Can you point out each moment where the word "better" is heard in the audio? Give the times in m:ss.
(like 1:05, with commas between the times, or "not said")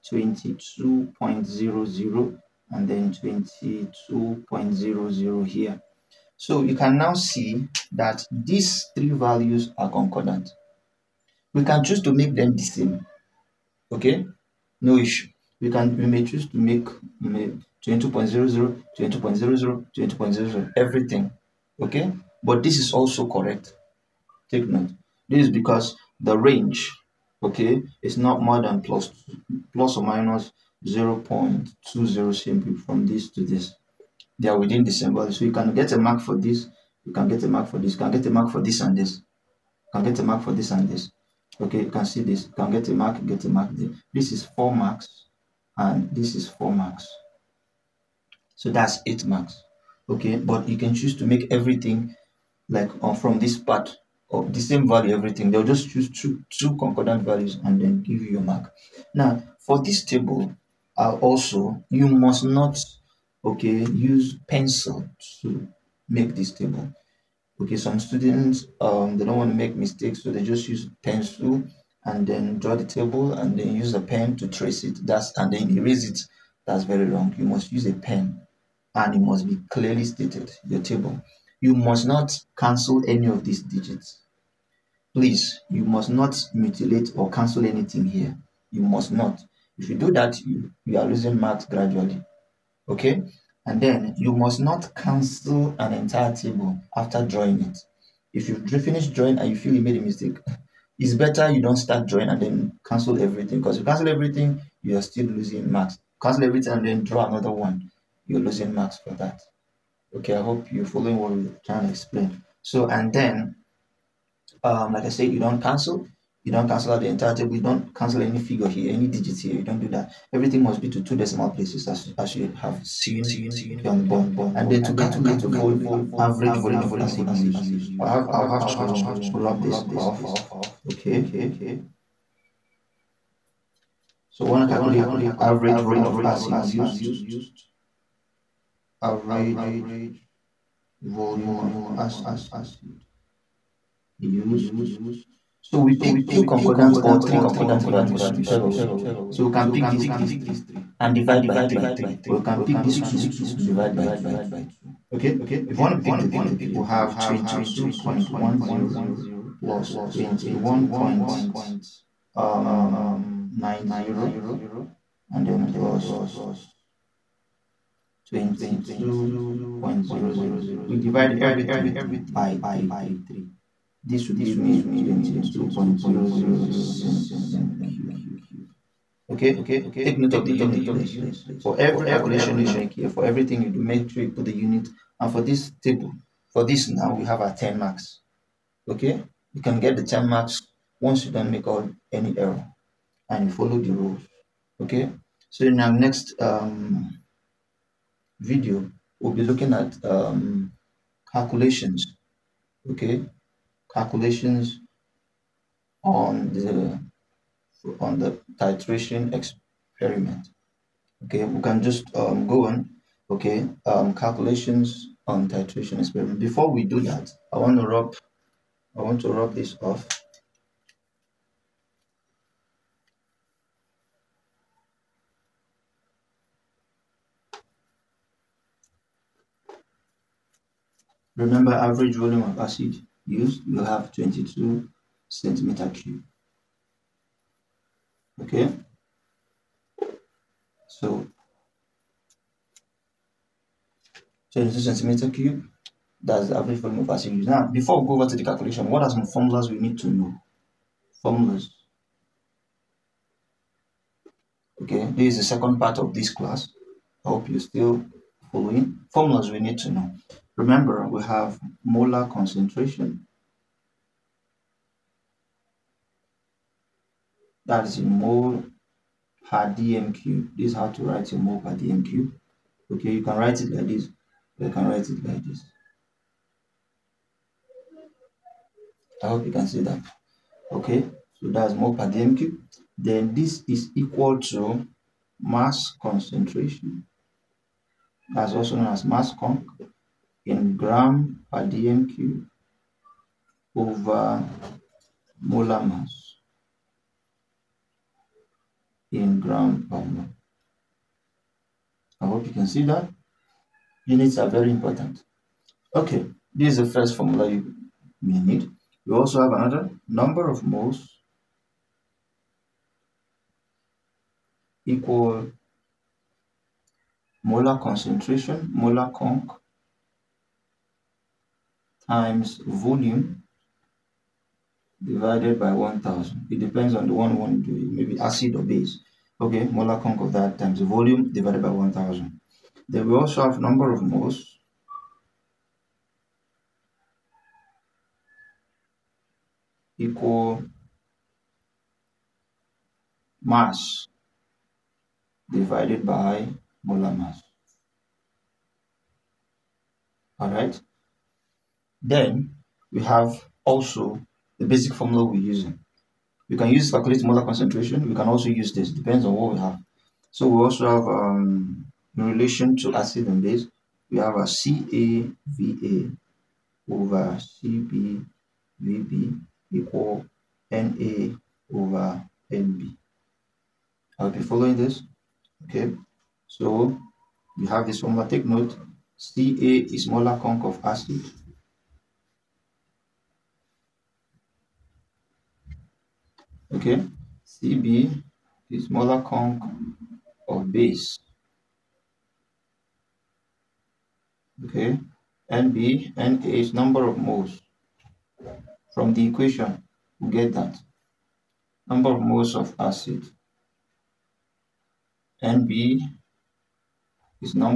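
1:41.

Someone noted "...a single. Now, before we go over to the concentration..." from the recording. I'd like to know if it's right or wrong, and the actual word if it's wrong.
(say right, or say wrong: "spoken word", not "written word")
wrong: "calculation", not "concentration".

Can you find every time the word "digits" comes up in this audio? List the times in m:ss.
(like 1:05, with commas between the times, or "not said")
1:23, 1:59.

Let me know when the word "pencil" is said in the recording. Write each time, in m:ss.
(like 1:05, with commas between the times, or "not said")
1:04, 1:11.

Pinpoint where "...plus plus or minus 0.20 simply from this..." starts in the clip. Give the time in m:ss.
0:28.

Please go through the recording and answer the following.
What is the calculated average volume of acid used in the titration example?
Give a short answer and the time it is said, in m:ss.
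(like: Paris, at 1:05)
22.00 cm3, at 2:55.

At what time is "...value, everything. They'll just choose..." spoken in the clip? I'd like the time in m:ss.
0:54.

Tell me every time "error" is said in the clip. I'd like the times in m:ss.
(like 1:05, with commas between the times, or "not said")
3:12.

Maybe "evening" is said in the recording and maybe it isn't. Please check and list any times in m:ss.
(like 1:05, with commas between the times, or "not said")
not said.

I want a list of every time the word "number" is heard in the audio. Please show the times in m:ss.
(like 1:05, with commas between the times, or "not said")
5:10, 5:33, 6:36, 6:41.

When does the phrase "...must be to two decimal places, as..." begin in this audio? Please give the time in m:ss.
2:00.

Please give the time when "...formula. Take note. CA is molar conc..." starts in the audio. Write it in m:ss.
6:18.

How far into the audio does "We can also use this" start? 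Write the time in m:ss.
5:58.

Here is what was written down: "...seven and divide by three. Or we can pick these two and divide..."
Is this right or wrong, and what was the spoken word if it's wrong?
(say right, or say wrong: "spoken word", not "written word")
wrong: "three", not "seven".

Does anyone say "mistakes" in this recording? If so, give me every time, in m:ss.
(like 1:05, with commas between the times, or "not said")
1:09, 1:40.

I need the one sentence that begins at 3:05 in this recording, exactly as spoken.
And for this table, for this now, we have our 10 marks.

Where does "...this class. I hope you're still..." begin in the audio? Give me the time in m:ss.
4:16.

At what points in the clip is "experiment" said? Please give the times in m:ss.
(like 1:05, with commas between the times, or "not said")
3:29, 3:35.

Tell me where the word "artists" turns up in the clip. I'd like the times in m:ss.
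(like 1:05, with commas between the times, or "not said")
not said.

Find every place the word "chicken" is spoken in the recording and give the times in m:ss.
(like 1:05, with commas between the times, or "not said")
not said.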